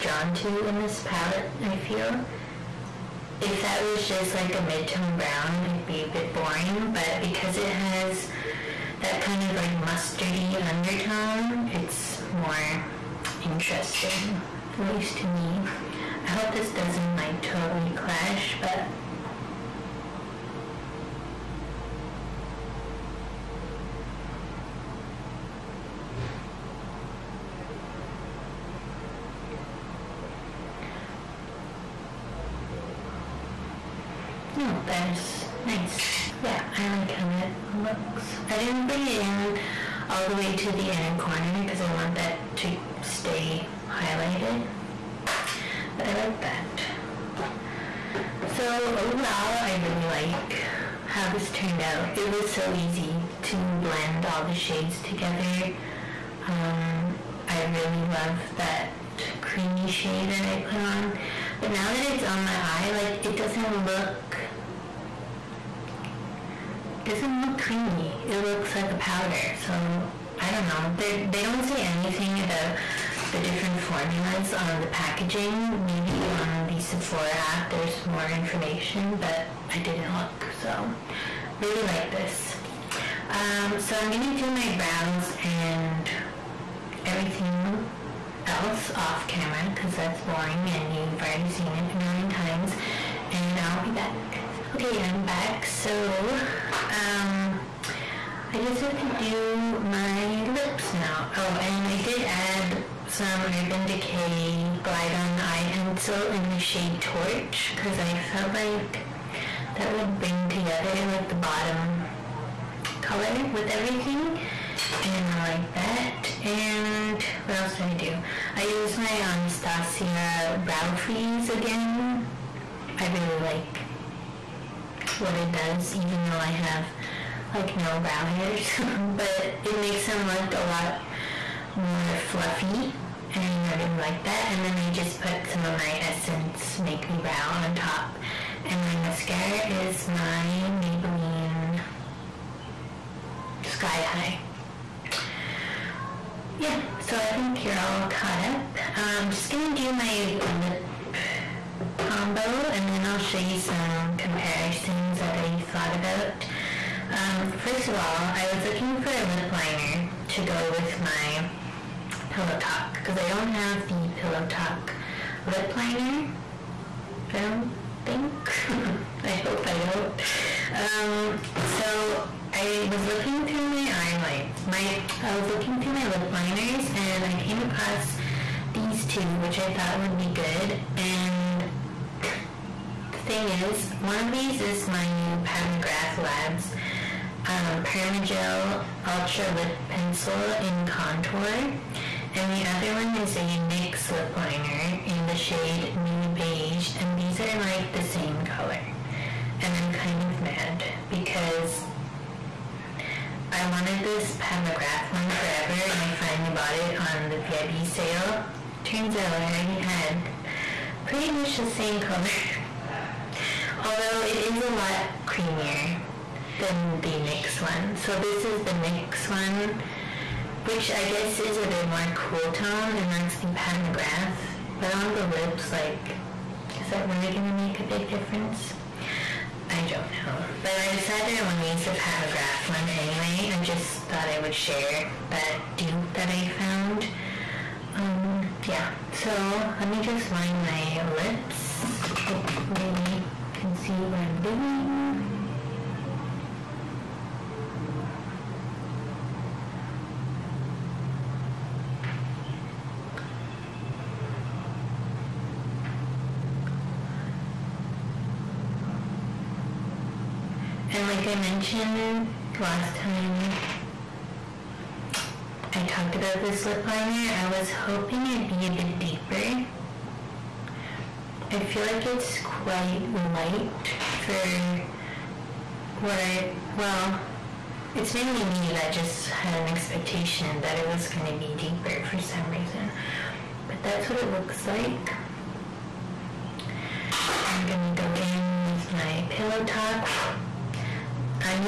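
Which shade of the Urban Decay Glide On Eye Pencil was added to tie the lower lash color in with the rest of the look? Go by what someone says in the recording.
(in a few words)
Torch.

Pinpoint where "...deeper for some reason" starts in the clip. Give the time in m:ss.
4:41.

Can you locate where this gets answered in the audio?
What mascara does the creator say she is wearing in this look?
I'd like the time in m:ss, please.
2:20.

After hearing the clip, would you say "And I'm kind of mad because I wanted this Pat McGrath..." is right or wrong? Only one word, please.
right.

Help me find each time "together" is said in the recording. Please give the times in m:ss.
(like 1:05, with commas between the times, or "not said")
0:55, 1:50.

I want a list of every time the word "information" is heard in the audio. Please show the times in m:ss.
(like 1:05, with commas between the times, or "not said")
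1:18.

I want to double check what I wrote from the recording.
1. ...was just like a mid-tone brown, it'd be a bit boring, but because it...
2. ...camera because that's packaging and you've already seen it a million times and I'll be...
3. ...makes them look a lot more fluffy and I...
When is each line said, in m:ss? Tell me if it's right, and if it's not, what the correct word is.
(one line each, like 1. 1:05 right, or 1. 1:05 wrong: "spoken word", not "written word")
1. 0:03 right
2. 1:29 wrong: "boring", not "packaging"
3. 2:09 right.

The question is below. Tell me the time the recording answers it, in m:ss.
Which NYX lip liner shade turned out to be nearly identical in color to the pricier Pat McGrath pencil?
3:15.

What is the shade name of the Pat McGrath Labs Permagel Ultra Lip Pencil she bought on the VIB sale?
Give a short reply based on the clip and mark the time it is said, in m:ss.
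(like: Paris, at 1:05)
Contour, at 3:10.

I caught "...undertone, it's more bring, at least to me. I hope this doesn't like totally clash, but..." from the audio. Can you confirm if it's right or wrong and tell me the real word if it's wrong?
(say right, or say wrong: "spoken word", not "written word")
wrong: "interesting", not "bring".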